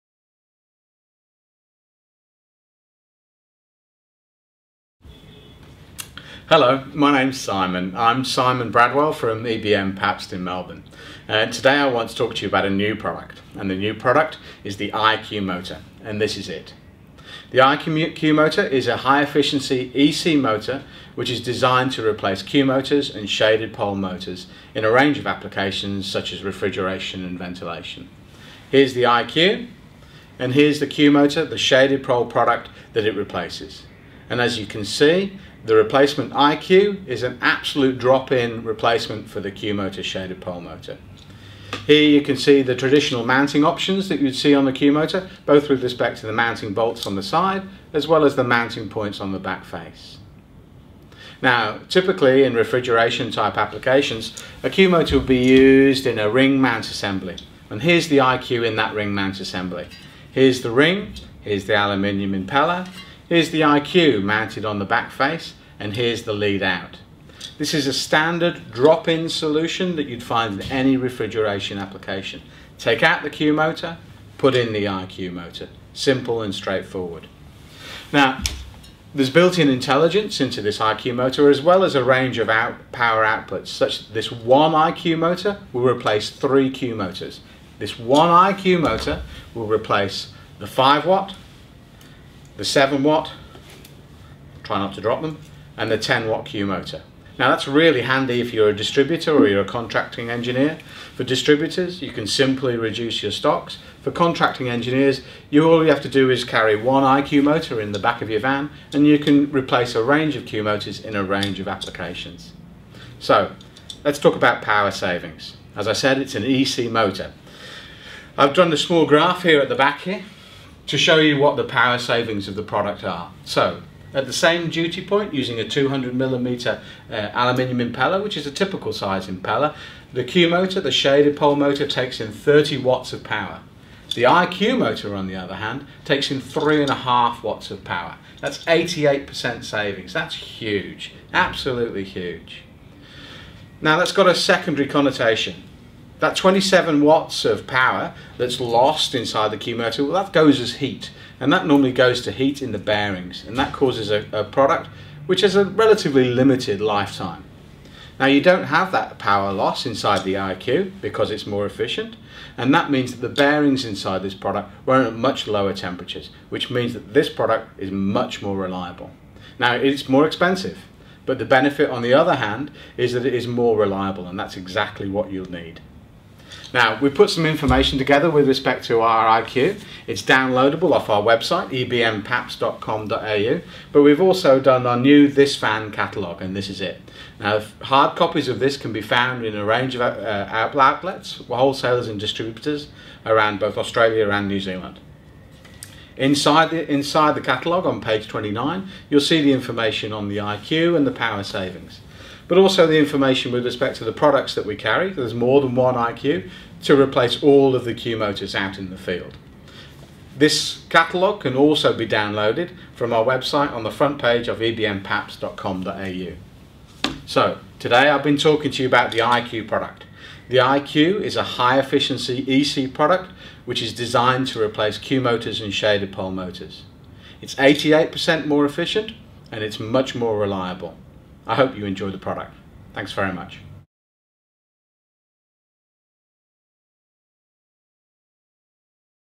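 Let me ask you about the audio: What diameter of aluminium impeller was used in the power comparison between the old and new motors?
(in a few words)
200 millimeter.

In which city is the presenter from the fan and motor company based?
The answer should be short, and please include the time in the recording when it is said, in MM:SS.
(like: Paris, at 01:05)
Melbourne, at 00:10.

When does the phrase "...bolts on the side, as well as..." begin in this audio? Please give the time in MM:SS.
00:46.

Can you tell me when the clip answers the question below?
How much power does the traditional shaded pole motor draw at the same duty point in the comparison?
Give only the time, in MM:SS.
02:12.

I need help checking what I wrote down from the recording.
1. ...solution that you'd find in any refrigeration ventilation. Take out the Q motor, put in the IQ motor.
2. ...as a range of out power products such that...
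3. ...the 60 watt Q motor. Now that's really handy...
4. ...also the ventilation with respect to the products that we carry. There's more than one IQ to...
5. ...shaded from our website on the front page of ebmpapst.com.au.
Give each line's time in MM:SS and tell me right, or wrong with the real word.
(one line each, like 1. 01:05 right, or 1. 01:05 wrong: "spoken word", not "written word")
1. 01:09 wrong: "application", not "ventilation"
2. 01:21 wrong: "outputs", not "products"
3. 01:35 wrong: "10", not "60"
4. 03:22 wrong: "information", not "ventilation"
5. 03:32 wrong: "downloaded", not "shaded".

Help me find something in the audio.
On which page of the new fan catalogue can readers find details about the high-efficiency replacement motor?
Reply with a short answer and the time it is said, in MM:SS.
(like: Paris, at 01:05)
29, at 03:17.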